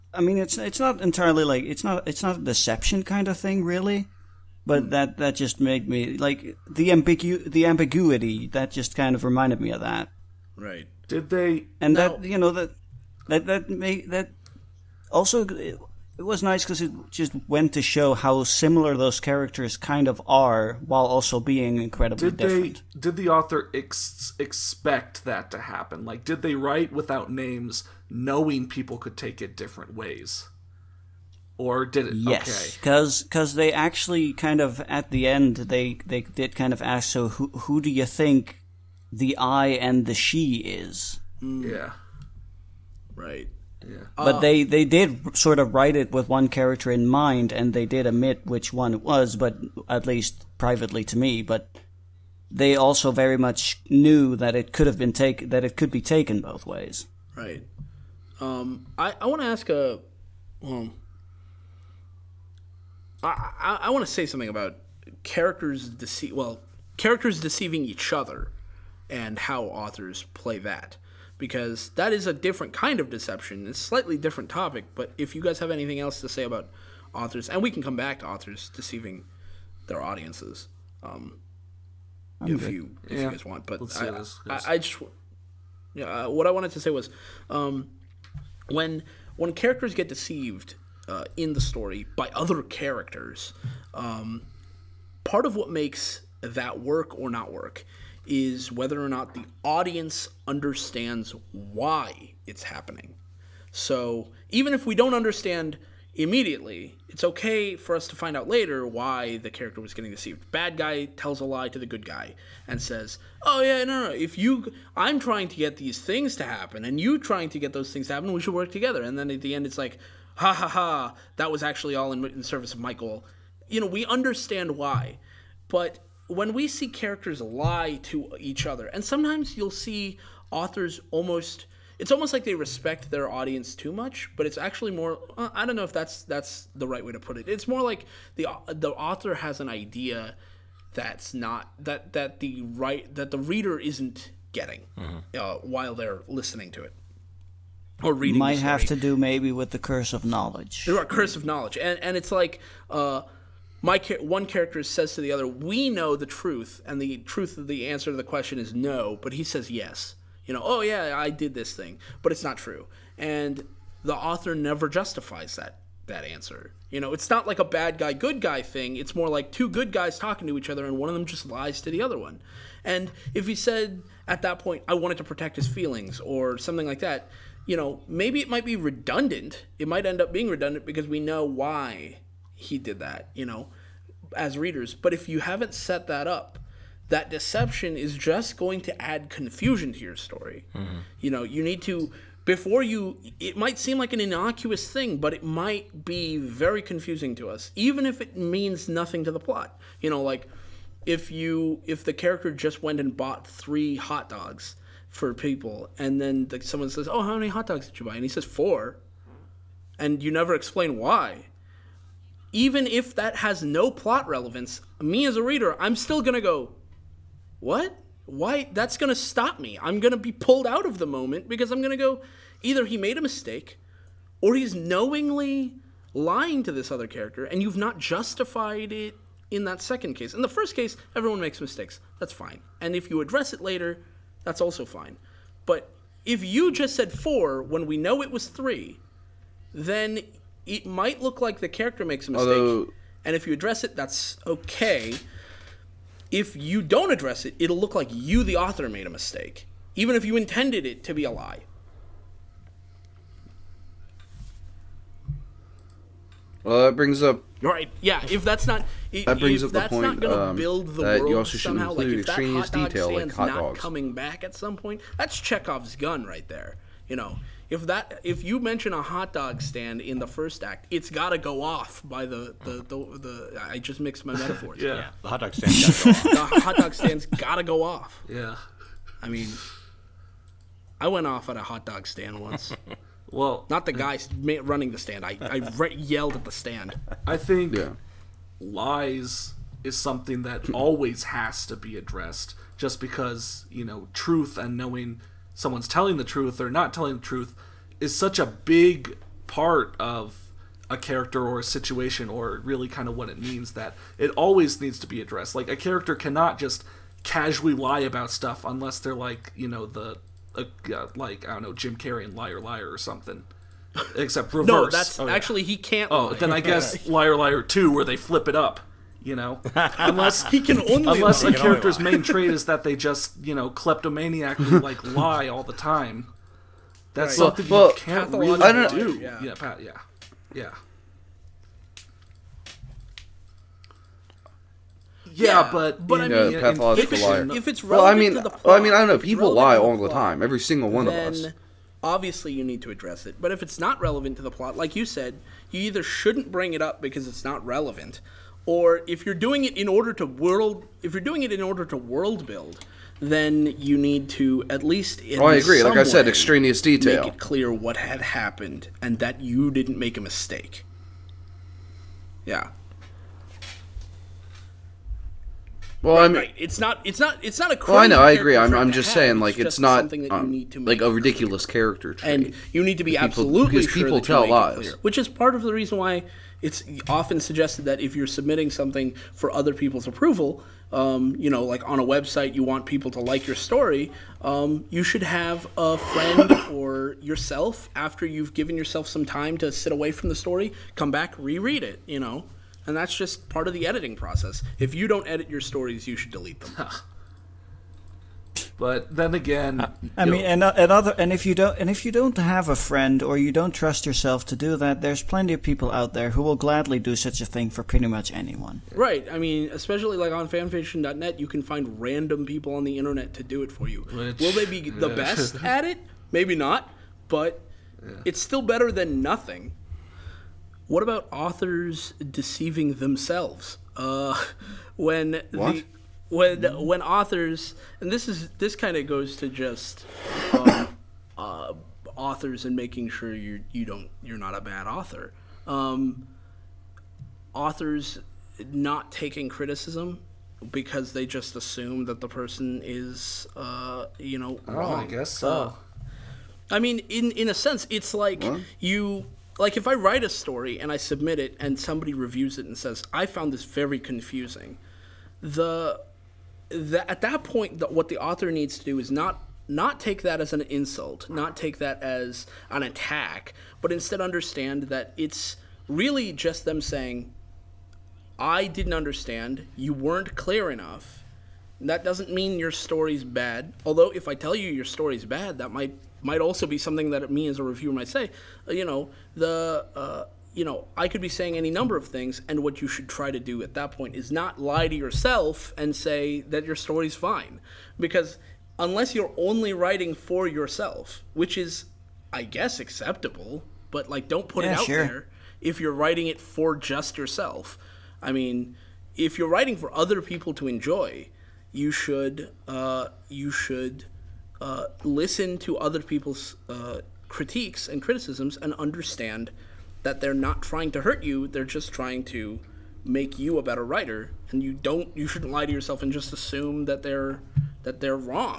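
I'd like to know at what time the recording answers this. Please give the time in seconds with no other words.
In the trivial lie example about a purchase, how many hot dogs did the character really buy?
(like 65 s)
203 s.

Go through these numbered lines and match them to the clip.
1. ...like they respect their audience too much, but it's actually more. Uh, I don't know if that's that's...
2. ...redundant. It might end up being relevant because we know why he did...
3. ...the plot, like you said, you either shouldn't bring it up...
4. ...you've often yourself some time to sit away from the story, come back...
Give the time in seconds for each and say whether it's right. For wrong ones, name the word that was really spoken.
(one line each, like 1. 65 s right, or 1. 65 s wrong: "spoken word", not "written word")
1. 132 s right
2. 178 s wrong: "redundant", not "relevant"
3. 344 s right
4. 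388 s wrong: "given", not "often".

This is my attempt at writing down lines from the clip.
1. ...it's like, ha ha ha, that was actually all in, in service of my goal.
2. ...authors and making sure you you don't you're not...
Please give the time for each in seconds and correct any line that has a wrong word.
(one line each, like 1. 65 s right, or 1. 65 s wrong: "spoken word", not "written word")
1. 119 s right
2. 432 s right.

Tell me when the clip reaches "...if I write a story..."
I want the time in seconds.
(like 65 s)
449 s.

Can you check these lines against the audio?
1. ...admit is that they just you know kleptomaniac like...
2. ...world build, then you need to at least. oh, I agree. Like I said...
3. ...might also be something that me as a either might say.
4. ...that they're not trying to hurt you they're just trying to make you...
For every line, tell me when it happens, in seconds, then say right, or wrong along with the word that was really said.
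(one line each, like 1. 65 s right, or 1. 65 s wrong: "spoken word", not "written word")
1. 322 s wrong: "trait", not "admit"
2. 351 s right
3. 476 s wrong: "reviewer", not "either"
4. 510 s right.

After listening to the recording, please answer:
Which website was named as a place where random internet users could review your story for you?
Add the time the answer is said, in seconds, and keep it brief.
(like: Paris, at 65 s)
fanfiction.net, at 410 s.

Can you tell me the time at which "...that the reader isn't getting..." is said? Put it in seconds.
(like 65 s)
143 s.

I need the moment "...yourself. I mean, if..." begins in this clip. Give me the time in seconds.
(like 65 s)
497 s.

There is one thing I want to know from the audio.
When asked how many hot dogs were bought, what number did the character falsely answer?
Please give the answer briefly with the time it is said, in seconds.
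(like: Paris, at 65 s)
4, at 208 s.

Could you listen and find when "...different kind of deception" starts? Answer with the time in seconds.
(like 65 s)
72 s.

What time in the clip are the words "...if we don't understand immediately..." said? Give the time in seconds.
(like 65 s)
104 s.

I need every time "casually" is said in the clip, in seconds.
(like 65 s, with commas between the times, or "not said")
307 s.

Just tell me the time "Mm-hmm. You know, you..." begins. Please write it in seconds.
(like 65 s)
190 s.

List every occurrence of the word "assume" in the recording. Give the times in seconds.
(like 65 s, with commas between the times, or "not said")
441 s, 516 s.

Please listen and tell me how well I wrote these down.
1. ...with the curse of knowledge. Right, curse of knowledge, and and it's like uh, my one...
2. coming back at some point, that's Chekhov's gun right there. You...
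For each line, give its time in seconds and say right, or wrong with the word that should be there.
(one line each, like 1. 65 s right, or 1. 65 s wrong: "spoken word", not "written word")
1. 149 s right
2. 263 s right.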